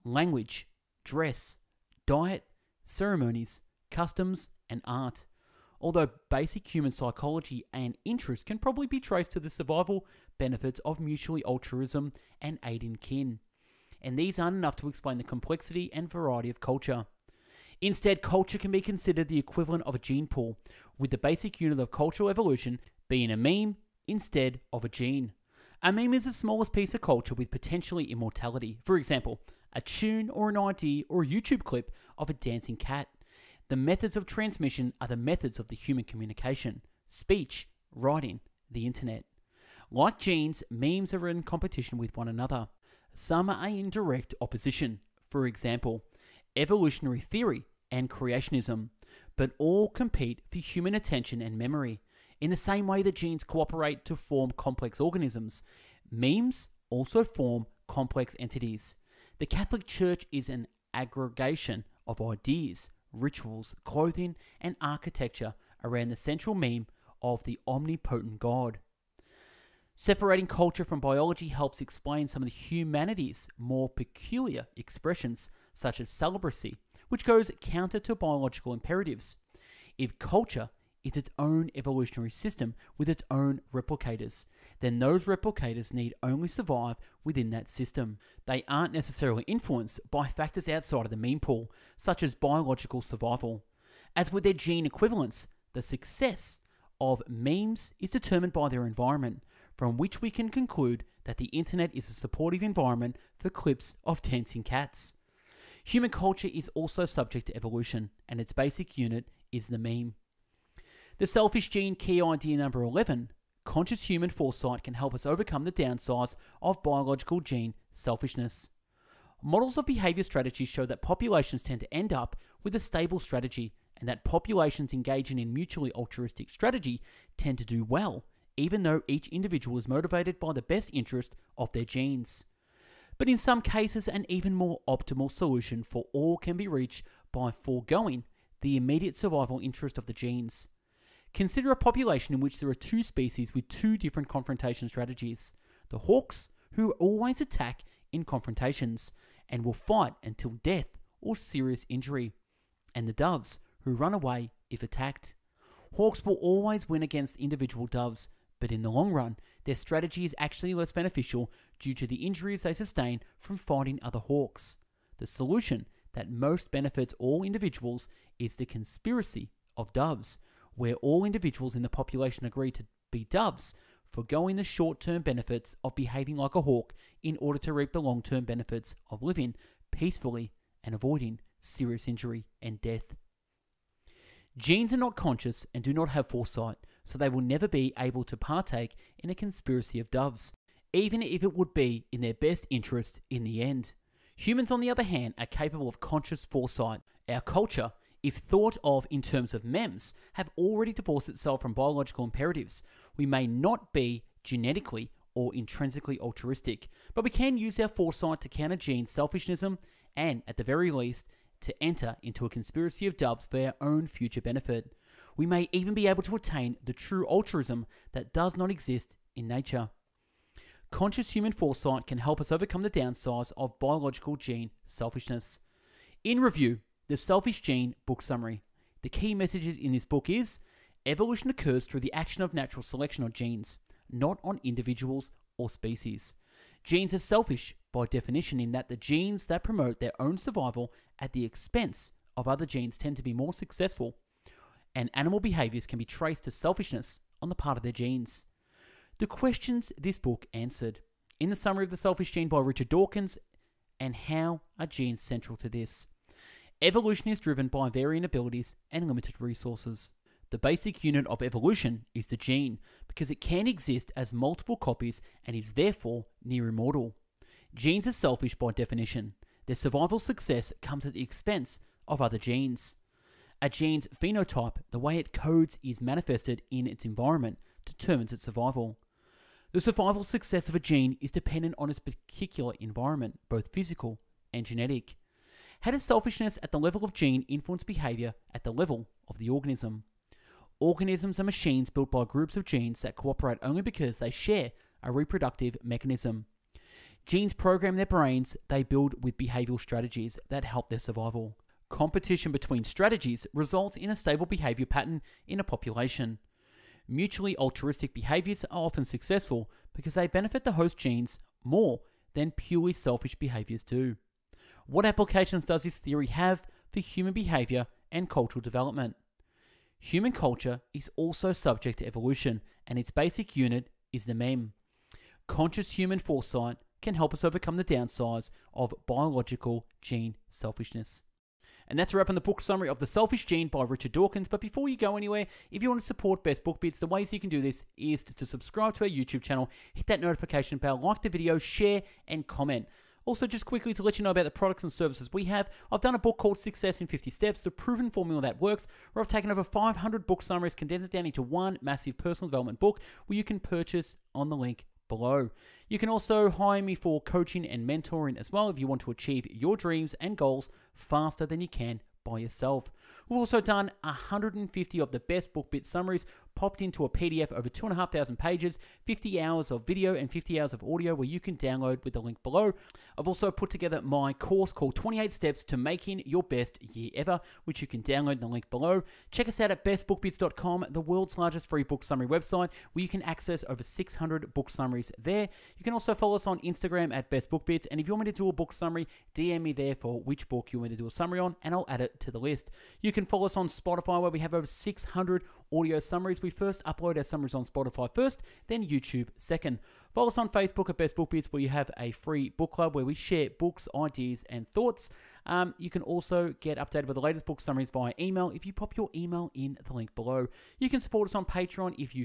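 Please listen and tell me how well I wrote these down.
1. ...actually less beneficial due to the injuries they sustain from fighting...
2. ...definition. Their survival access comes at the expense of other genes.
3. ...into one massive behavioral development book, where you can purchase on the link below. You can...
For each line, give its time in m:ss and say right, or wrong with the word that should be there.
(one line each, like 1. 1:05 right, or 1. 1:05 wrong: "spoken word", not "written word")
1. 2:40 right
2. 4:28 wrong: "success", not "access"
3. 5:51 wrong: "personal", not "behavioral".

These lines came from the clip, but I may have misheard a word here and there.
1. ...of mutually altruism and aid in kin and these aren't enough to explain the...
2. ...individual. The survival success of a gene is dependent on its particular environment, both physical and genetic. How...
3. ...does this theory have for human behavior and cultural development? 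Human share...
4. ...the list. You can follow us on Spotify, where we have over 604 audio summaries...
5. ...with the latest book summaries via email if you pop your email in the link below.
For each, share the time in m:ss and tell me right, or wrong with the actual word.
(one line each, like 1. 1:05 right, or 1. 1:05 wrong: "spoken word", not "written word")
1. 0:10 right
2. 4:38 wrong: "survival", not "individual"
3. 5:15 wrong: "culture", not "share"
4. 6:32 wrong: "600", not "604"
5. 6:47 right.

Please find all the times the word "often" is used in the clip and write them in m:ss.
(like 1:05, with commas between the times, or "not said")
5:08.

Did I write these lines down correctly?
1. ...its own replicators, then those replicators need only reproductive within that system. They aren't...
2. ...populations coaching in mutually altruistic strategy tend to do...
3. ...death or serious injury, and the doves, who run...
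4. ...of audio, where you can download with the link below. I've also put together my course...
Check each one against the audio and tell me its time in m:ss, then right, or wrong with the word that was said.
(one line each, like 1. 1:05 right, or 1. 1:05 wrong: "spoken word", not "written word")
1. 1:23 wrong: "survive", not "reproductive"
2. 2:04 wrong: "engaging", not "coaching"
3. 2:30 right
4. 6:10 right.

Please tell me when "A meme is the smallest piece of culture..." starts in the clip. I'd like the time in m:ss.
0:25.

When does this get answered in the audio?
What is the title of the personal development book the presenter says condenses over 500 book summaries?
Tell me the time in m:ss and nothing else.
5:46.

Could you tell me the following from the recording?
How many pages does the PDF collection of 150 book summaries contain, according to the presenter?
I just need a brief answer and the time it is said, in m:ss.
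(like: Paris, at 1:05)
over 2,500, at 6:07.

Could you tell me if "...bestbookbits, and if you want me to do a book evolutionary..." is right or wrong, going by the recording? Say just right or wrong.
wrong.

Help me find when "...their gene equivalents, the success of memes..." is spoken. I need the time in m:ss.
1:34.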